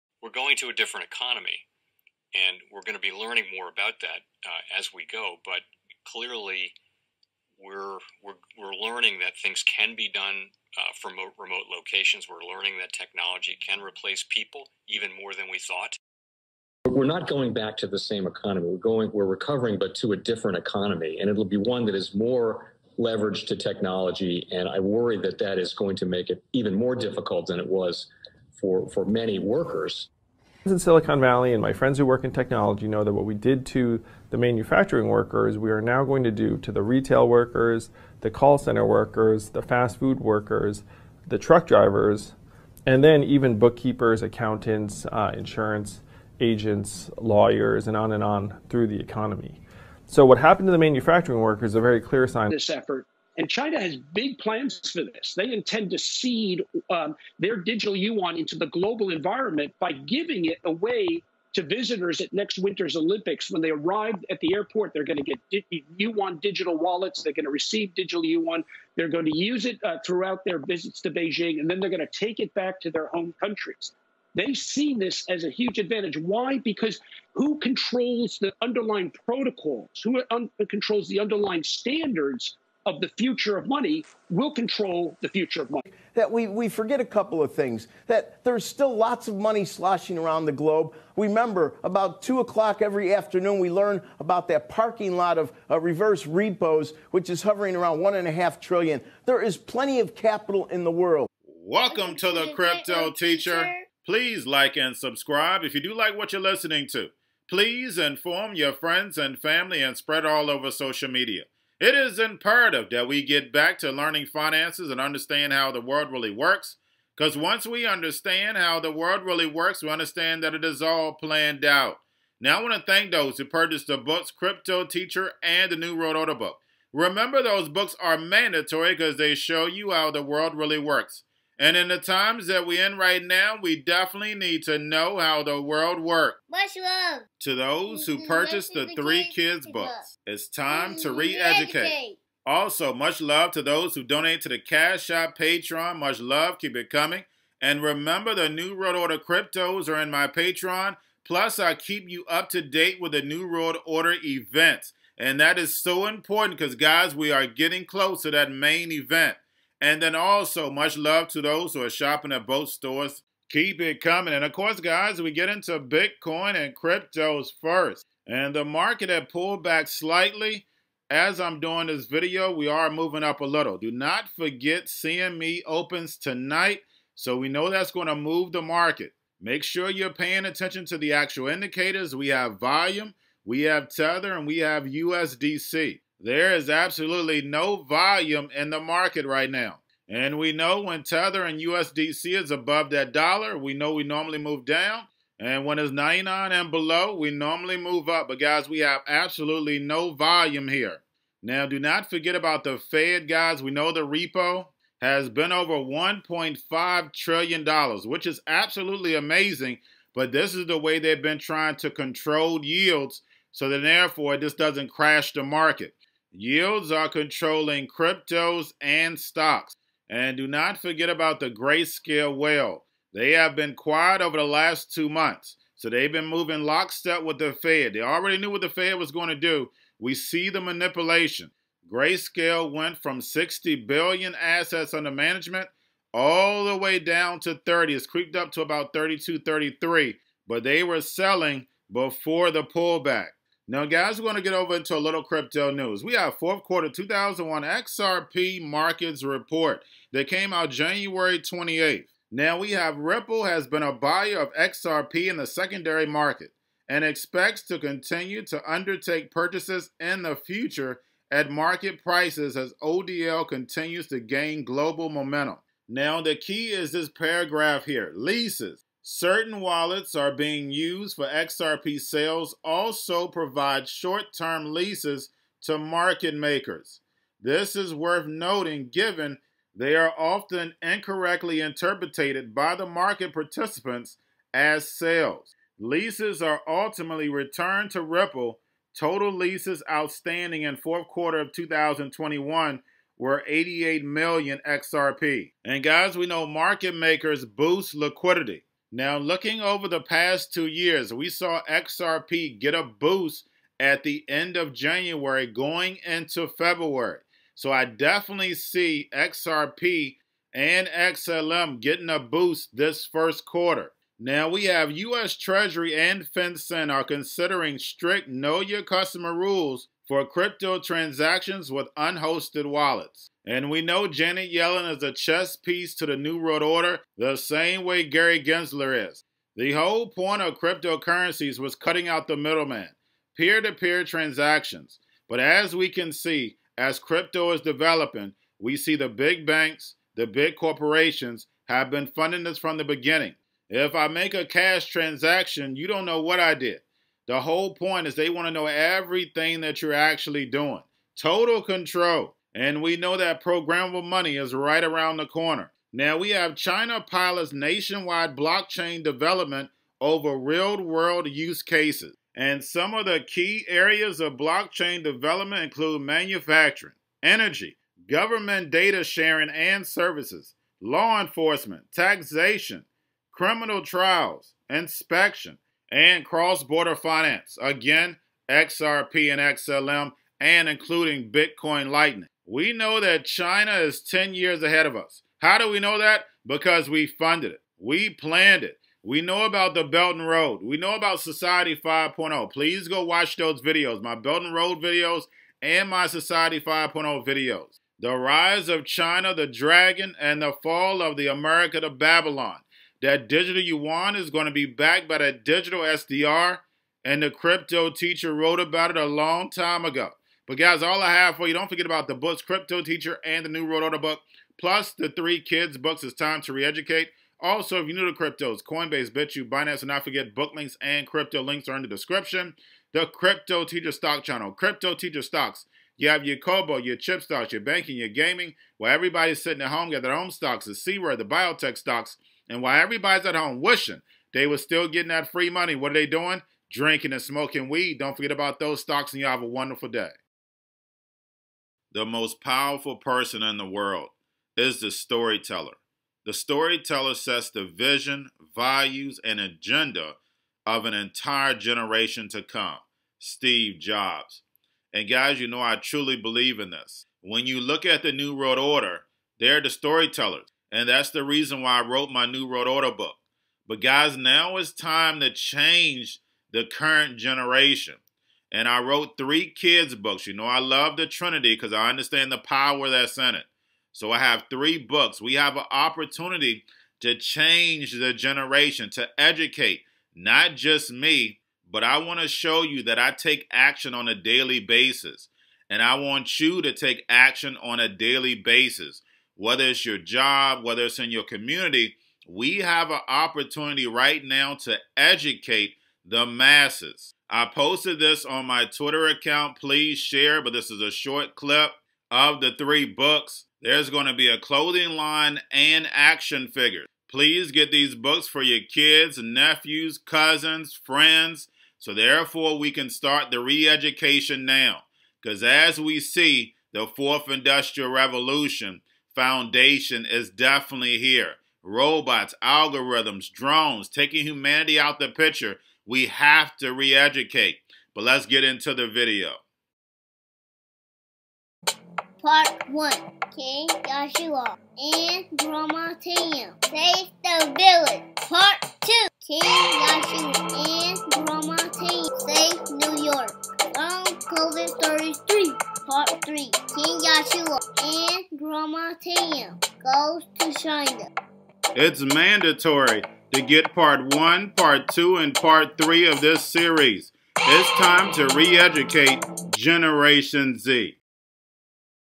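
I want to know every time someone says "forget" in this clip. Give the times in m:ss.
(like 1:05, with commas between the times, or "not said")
1:26, 2:54, 3:22, 3:40, 6:51, 7:00, 7:18.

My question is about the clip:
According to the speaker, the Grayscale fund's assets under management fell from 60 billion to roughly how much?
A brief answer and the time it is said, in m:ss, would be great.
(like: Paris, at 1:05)
30, at 3:56.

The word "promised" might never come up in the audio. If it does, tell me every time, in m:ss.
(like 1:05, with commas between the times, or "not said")
not said.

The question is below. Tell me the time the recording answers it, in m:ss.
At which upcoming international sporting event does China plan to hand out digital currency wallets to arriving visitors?
1:02.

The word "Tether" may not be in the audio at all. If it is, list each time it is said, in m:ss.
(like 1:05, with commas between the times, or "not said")
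3:03, 3:11.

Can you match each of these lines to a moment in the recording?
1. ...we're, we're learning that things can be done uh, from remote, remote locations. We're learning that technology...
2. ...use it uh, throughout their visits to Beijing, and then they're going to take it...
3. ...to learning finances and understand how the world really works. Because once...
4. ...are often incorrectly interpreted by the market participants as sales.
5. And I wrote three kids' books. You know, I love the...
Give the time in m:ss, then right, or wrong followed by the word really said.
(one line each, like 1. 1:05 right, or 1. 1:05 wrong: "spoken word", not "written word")
1. 0:08 right
2. 1:09 right
3. 1:53 right
4. 4:39 right
5. 7:48 right.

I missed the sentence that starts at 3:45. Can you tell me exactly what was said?
So they've been moving lockstep with the Fed.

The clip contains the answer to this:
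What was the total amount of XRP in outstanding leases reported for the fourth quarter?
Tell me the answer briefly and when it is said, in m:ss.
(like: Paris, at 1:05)
88 million XRP, at 4:53.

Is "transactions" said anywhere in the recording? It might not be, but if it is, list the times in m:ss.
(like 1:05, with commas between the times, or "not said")
5:20, 5:34, 5:44.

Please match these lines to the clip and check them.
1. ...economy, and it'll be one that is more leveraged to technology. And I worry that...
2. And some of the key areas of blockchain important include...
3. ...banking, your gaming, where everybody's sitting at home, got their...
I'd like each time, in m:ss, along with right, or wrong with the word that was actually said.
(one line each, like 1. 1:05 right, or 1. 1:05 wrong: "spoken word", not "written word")
1. 0:20 right
2. 6:02 wrong: "development", not "important"
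3. 7:07 right.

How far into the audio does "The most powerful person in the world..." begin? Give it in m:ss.
7:21.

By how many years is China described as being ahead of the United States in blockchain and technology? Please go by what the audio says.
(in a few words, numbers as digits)
10 years.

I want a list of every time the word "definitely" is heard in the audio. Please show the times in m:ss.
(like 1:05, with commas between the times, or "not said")
2:13, 5:07, 8:40.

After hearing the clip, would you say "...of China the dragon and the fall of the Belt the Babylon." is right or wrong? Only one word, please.
wrong.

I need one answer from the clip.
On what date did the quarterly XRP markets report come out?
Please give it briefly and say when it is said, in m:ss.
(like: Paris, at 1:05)
January 28th, at 4:10.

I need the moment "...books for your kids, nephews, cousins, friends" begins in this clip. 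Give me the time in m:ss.
8:27.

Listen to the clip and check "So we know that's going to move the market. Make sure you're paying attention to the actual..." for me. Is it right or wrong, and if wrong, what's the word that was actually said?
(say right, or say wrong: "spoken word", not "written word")
right.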